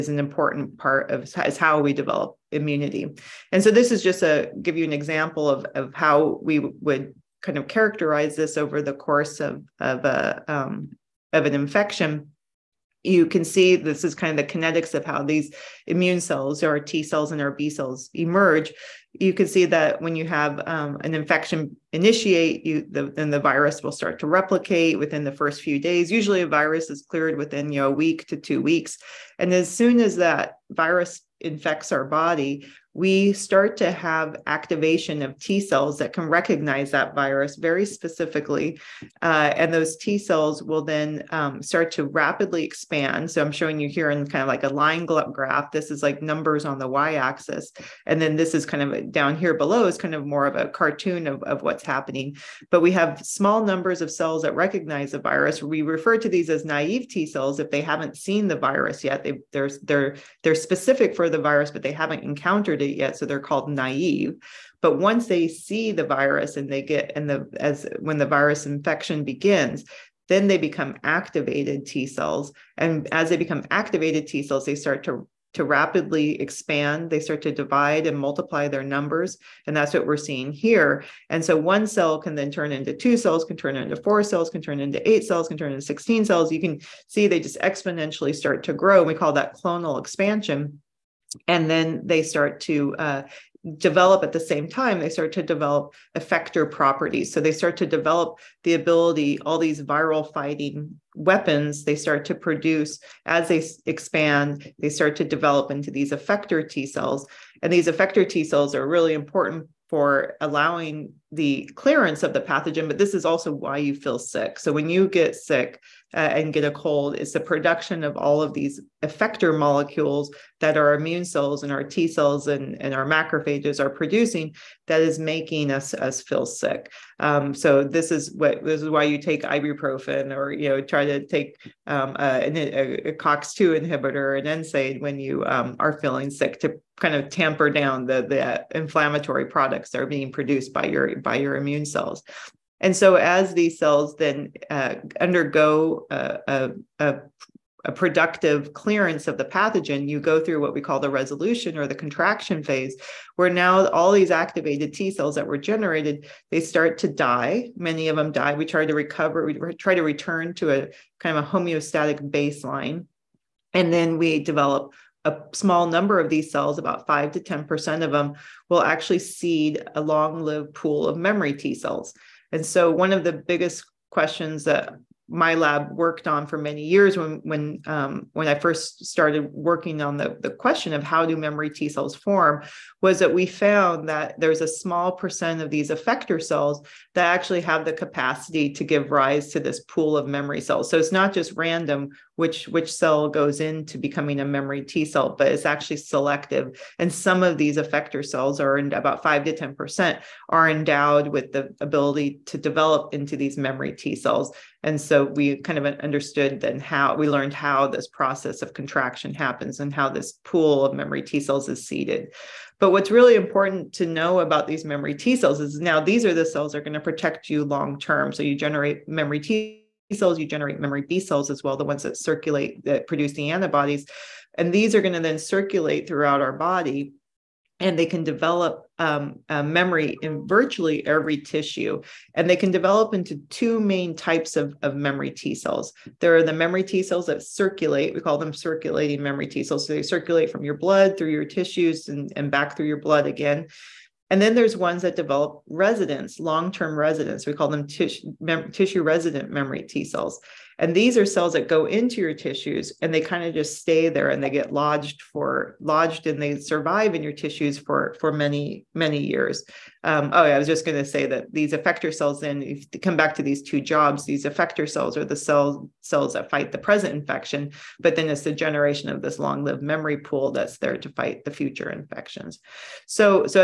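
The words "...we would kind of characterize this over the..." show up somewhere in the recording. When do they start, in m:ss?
0:06.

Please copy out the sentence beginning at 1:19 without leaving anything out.
And that's what we're seeing here.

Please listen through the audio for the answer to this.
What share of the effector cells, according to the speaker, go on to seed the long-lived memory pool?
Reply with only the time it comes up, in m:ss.
2:47.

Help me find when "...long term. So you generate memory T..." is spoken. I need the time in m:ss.
3:37.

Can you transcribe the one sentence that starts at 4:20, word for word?
Um, oh, yeah, I was just going to say that these effector cells.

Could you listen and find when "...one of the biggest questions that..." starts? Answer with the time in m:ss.
2:52.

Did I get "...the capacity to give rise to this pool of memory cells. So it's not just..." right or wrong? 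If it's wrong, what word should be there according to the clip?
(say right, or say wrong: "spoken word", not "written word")
right.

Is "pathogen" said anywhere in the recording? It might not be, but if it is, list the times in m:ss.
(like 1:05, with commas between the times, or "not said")
1:52, 2:29.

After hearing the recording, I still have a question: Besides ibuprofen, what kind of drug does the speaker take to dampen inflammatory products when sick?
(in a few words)
COX2 inhibitor.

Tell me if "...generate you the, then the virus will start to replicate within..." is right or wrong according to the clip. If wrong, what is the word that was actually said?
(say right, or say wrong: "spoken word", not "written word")
wrong: "initiate", not "generate".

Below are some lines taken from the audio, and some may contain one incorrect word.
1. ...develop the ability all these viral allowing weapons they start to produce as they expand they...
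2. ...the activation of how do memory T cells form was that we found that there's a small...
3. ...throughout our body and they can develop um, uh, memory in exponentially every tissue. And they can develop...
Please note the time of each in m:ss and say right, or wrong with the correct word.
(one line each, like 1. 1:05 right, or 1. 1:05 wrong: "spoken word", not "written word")
1. 1:37 wrong: "fighting", not "allowing"
2. 3:00 wrong: "question", not "activation"
3. 3:46 wrong: "virtually", not "exponentially".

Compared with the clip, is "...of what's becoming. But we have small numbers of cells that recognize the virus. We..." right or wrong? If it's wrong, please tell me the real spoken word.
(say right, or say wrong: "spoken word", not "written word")
wrong: "happening", not "becoming".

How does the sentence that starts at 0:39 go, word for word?
Uh, and those T cells will then um, start to rapidly expand.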